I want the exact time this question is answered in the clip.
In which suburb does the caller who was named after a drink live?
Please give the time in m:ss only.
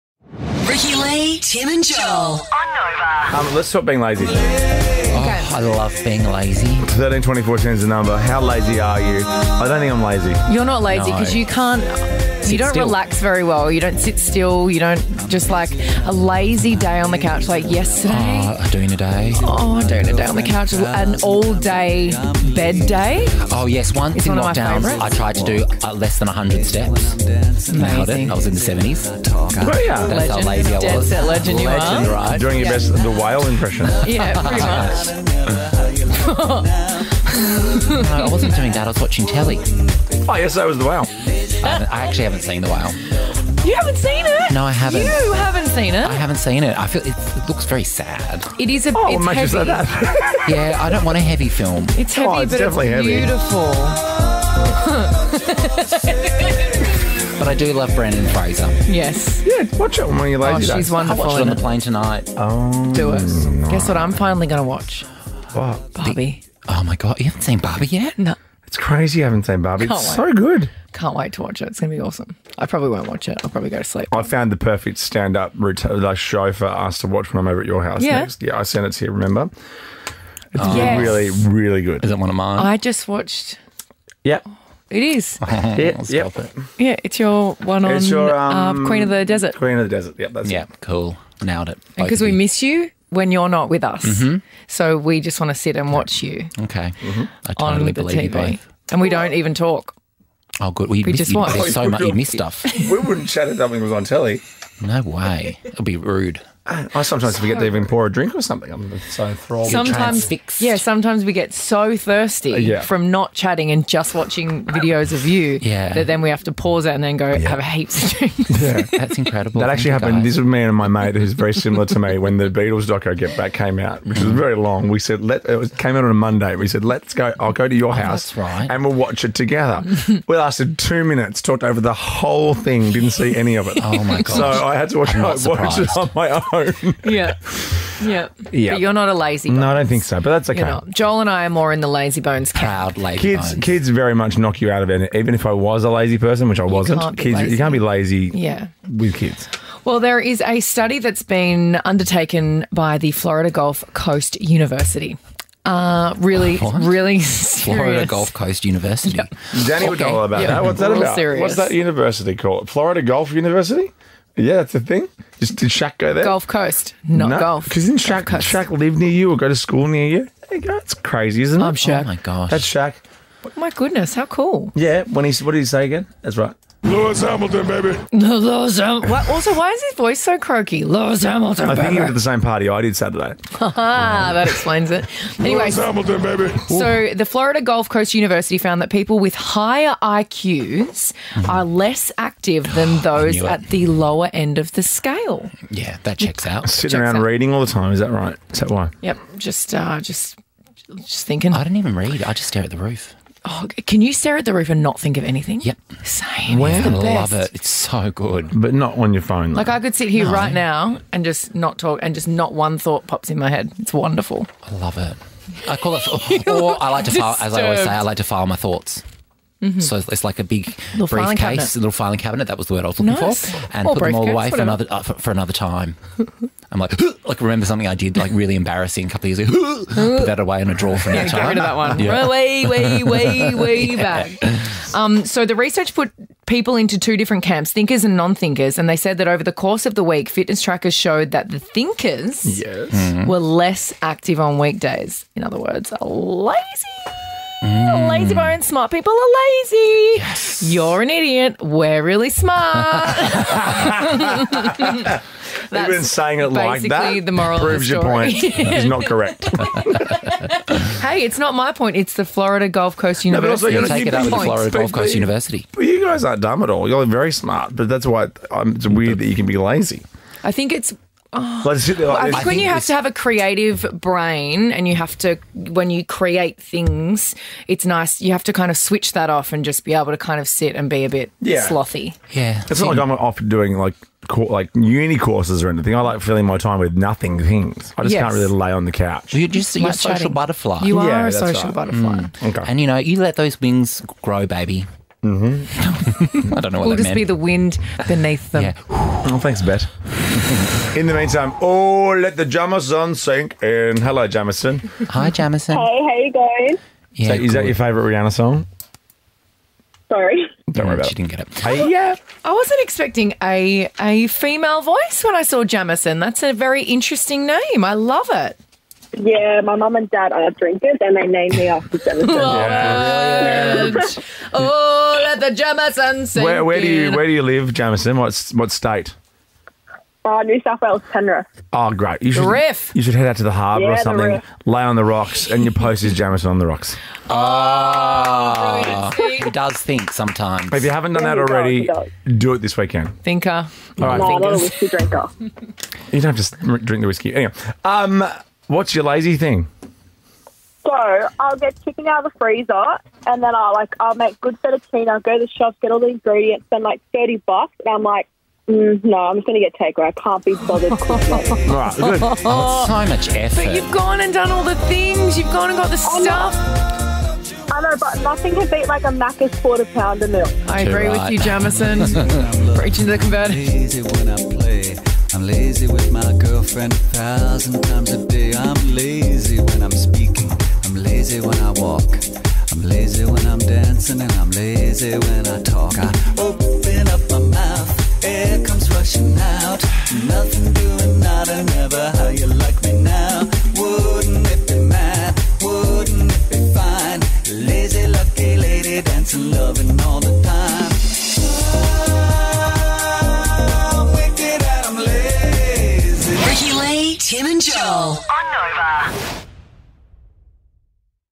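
5:31.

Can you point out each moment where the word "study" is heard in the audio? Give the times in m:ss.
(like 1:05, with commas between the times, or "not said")
2:30.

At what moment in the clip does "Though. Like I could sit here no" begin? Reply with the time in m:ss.
3:29.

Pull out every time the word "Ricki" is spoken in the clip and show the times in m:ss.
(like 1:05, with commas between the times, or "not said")
0:00.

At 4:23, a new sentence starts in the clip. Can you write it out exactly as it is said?
No, also, you, you take it up with the Florida Gulf Coast but, University.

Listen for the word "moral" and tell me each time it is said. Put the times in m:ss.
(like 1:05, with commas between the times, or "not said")
4:17.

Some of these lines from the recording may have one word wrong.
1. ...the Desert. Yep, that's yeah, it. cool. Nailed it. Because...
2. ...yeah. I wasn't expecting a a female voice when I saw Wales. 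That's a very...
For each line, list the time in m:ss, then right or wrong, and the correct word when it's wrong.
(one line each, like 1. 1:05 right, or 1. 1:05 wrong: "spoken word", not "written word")
1. 1:29 right
2. 5:11 wrong: "Jamison", not "Wales".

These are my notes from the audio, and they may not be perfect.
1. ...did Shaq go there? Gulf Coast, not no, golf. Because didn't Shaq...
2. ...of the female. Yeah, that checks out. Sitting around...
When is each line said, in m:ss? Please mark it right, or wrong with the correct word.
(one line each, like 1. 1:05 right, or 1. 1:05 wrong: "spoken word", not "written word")
1. 2:45 right
2. 3:14 wrong: "scale", not "female".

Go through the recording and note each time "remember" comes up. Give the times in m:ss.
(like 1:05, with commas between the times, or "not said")
1:19, 3:47.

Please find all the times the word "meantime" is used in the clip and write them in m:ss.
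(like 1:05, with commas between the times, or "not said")
5:01.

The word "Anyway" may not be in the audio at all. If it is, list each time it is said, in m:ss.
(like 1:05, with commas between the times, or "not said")
3:05, 5:47.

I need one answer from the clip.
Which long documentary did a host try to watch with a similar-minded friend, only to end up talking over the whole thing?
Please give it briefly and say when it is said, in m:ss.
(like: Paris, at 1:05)
Get Back, at 2:03.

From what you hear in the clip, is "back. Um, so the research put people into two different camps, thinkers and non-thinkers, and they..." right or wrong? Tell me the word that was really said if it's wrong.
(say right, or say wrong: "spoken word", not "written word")
right.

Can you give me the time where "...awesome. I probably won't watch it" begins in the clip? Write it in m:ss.
1:12.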